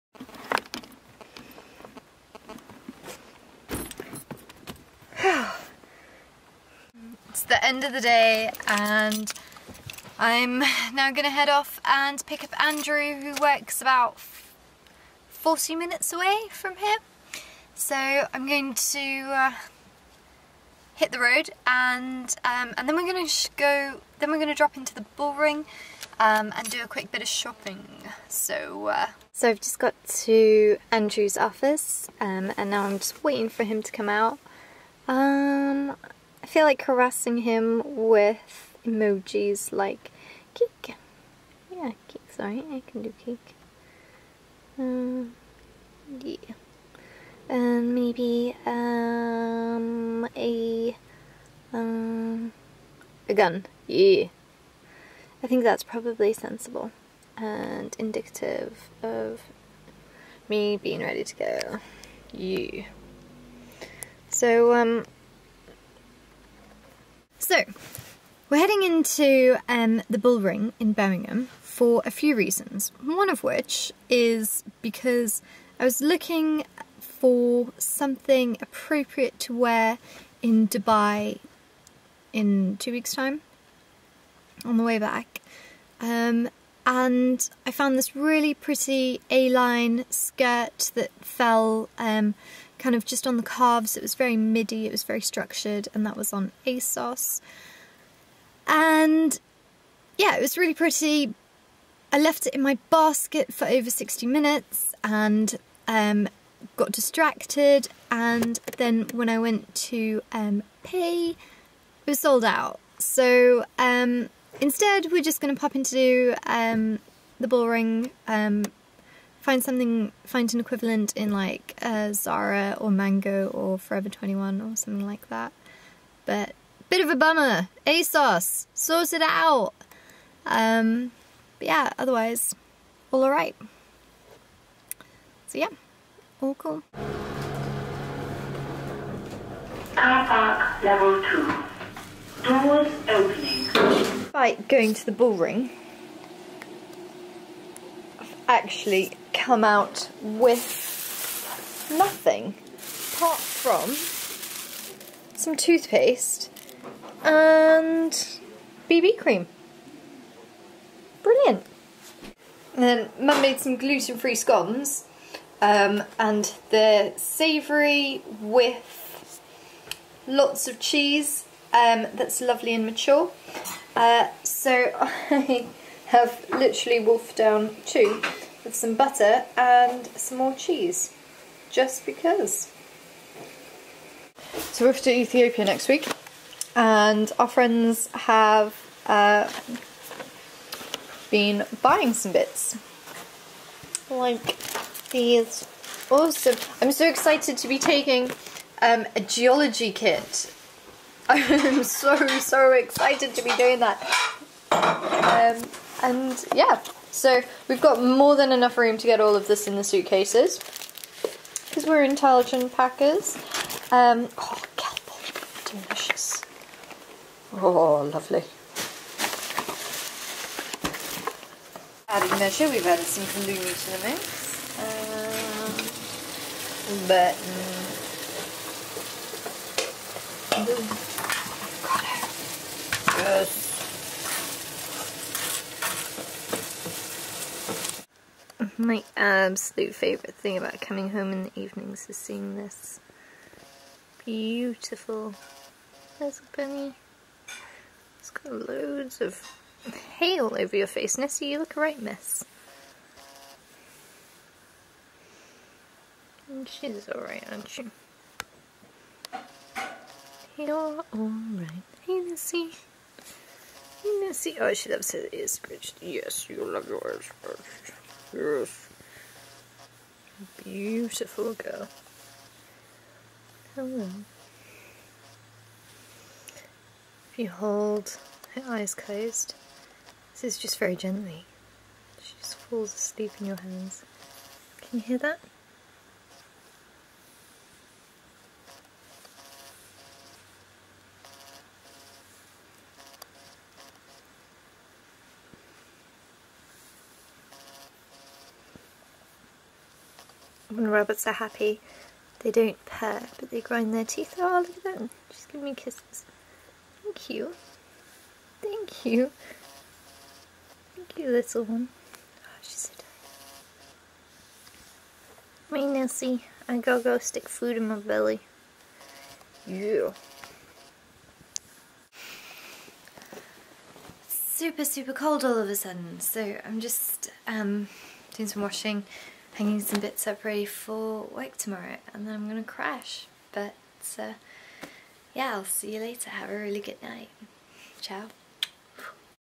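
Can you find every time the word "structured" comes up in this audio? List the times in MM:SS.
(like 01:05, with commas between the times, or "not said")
01:35.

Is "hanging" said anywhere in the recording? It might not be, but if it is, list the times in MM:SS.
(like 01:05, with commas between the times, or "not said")
05:29.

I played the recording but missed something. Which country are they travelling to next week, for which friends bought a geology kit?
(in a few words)
Ethiopia.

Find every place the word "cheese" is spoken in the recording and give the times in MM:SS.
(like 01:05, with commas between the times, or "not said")
02:50, 03:00.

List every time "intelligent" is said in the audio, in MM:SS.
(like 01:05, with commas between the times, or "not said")
03:32.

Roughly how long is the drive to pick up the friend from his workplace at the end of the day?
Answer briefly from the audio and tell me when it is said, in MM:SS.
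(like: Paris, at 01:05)
40 minutes, at 00:15.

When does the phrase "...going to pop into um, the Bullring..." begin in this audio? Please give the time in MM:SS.
01:55.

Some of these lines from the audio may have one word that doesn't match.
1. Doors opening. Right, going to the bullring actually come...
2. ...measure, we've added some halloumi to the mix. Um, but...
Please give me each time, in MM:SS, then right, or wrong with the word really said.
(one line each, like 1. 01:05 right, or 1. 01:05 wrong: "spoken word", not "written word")
1. 02:22 right
2. 03:42 right.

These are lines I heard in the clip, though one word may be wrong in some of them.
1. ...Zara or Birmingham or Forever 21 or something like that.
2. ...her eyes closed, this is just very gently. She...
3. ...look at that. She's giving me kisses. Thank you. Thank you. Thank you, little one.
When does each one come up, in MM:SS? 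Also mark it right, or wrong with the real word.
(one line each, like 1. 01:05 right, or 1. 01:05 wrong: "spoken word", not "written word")
1. 02:02 wrong: "Mango", not "Birmingham"
2. 04:38 right
3. 05:04 right.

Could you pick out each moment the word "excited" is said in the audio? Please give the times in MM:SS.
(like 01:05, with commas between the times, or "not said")
03:17, 03:22.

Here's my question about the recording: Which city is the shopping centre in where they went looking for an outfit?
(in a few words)
Birmingham.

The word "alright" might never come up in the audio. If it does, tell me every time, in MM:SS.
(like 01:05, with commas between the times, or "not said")
02:13, 04:17, 04:21.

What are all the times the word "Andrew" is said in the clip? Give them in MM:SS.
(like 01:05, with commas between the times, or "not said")
00:12, 00:30.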